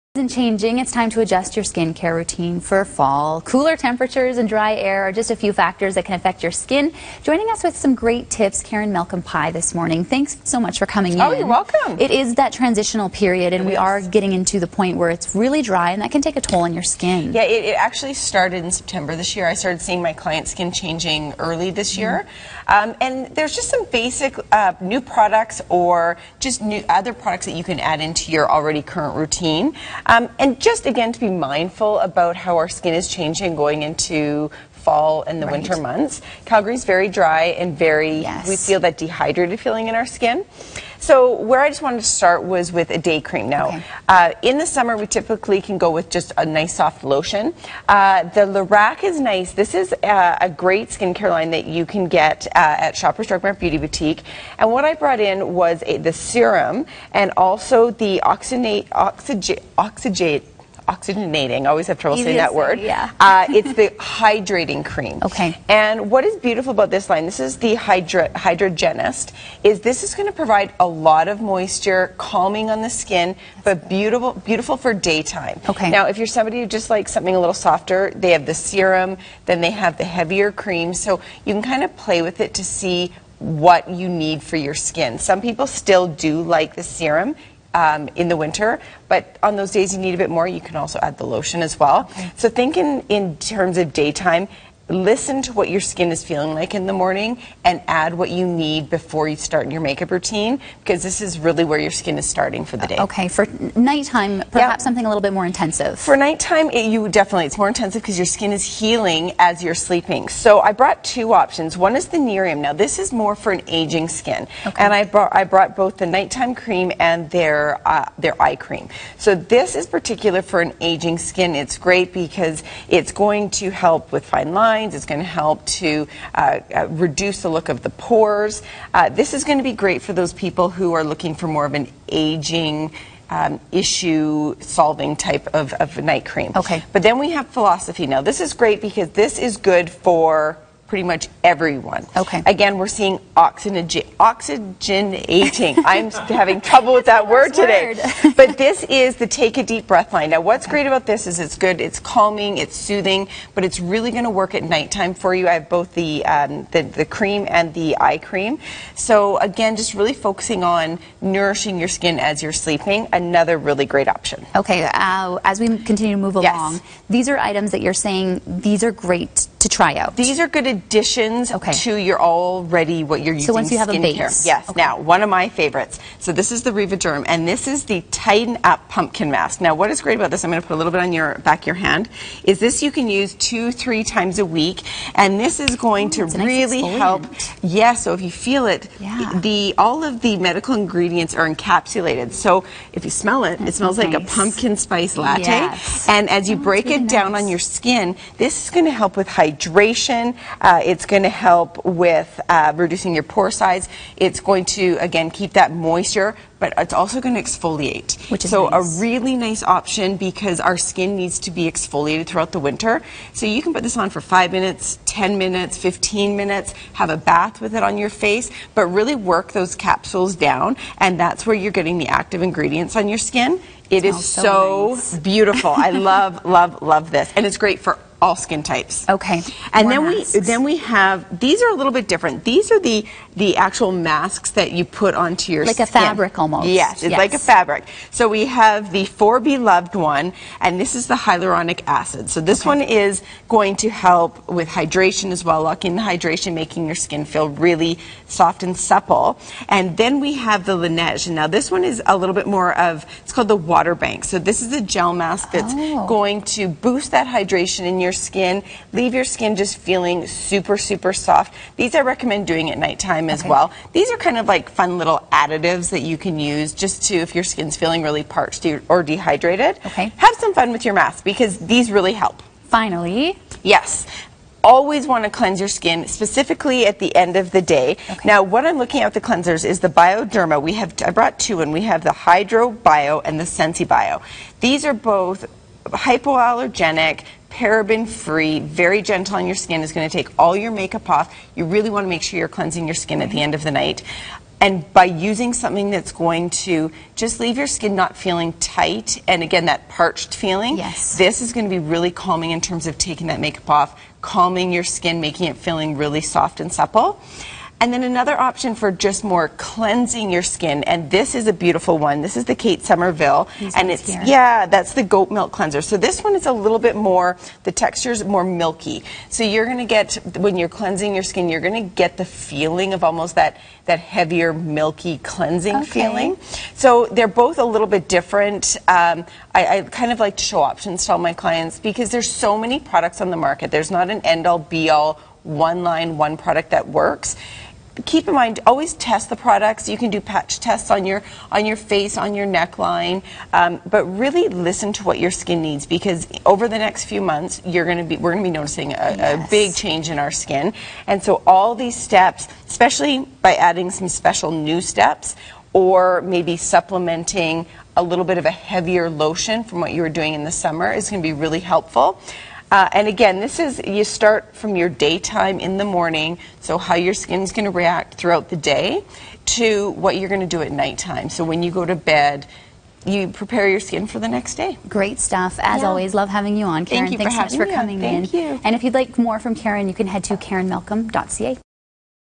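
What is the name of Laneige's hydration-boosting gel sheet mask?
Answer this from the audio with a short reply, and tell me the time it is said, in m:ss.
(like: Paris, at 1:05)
water bank, at 4:13.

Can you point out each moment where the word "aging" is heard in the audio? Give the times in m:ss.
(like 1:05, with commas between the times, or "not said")
1:53, 2:00, 2:12.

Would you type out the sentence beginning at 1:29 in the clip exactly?
But on those days you need a bit more, you can also add the lotion as well.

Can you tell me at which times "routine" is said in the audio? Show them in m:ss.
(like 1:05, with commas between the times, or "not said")
0:02, 0:29, 1:40.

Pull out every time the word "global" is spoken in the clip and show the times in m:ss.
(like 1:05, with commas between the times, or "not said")
not said.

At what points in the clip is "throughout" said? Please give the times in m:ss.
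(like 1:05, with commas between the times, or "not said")
3:32, 6:08.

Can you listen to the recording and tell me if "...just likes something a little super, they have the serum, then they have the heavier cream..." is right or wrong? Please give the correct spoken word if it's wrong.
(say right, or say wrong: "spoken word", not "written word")
wrong: "softer", not "super".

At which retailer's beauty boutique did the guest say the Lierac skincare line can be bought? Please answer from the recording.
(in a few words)
Shoppers Drug Mart.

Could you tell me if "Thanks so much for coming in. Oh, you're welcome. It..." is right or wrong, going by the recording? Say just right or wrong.
right.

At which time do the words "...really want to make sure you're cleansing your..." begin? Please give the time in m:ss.
4:51.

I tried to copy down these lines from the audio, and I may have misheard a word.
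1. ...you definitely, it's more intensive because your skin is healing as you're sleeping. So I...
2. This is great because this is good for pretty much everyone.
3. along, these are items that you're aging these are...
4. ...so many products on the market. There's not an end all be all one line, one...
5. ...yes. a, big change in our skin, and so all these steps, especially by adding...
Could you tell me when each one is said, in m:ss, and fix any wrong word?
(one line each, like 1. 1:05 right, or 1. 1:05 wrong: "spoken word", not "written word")
1. 1:46 right
2. 2:18 right
3. 2:46 wrong: "saying", not "aging"
4. 5:32 right
5. 5:48 right.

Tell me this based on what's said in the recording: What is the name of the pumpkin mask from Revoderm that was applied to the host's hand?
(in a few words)
Tighten Up Pumpkin Mask.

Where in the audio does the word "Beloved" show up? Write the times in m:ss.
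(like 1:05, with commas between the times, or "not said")
3:59.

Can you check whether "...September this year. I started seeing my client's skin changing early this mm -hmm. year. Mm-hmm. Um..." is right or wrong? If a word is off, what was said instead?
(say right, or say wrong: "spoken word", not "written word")
right.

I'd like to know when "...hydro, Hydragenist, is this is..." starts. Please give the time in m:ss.
1:07.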